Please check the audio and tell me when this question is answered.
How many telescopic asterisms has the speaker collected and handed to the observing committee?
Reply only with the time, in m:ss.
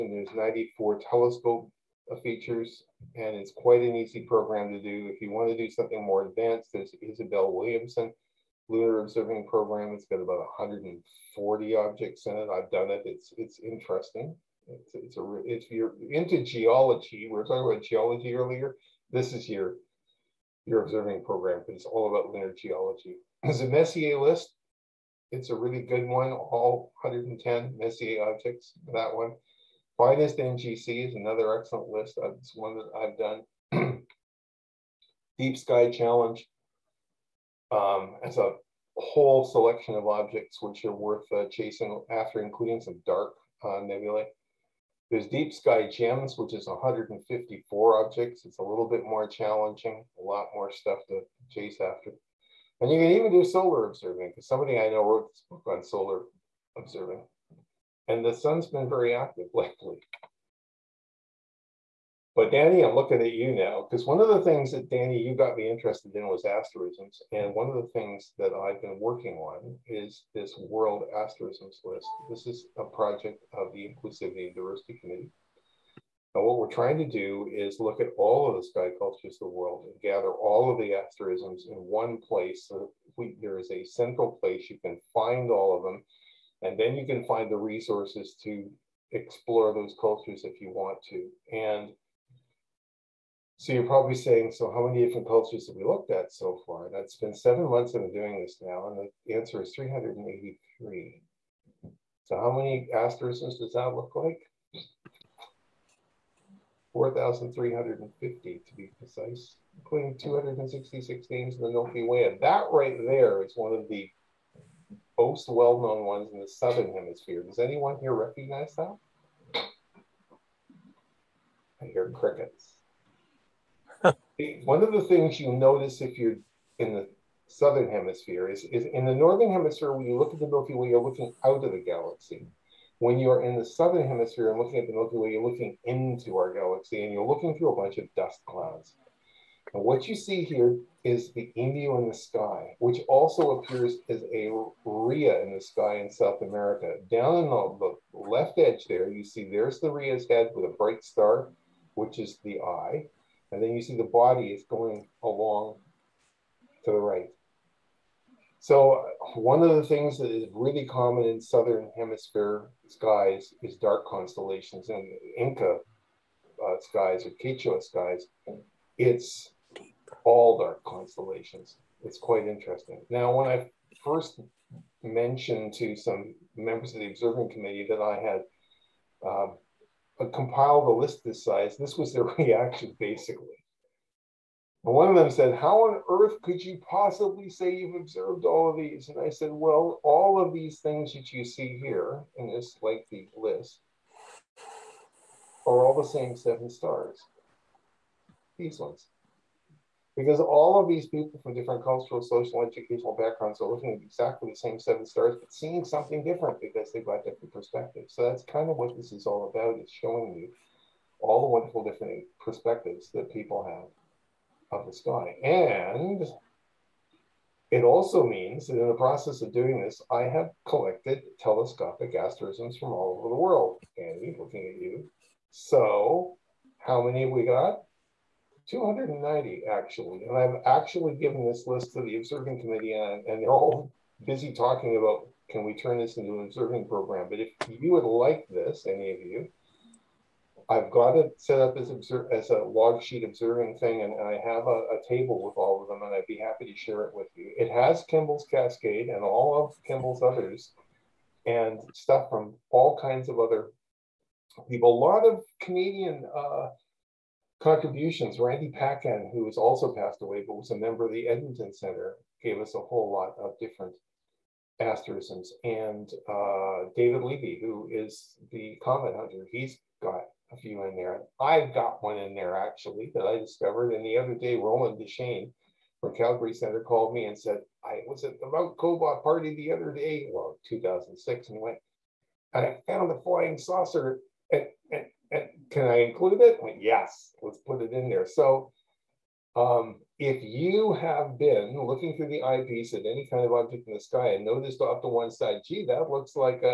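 3:48.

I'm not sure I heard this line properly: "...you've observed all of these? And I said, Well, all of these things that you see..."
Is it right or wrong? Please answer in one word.
right.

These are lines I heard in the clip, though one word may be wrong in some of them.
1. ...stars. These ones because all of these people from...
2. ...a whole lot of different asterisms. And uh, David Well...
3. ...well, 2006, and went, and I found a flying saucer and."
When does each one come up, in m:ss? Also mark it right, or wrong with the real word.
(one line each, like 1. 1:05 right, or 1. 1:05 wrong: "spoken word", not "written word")
1. 3:16 right
2. 4:22 wrong: "Levy", not "Well"
3. 4:40 right.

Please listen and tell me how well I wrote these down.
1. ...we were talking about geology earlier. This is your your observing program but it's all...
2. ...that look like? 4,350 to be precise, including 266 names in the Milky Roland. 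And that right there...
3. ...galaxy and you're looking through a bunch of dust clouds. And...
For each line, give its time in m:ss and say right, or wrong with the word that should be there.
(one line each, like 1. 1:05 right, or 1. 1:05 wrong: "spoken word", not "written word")
1. 0:17 right
2. 1:43 wrong: "Way", not "Roland"
3. 2:16 right.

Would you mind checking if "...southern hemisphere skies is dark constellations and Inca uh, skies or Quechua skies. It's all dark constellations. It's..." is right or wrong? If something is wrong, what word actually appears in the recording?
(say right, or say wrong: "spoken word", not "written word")
right.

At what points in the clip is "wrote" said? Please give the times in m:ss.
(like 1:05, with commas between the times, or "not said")
0:55.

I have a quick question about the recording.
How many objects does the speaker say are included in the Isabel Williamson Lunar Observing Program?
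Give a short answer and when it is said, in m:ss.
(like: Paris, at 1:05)
140, at 0:10.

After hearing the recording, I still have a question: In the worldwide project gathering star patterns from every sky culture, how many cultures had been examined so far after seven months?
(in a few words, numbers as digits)
383.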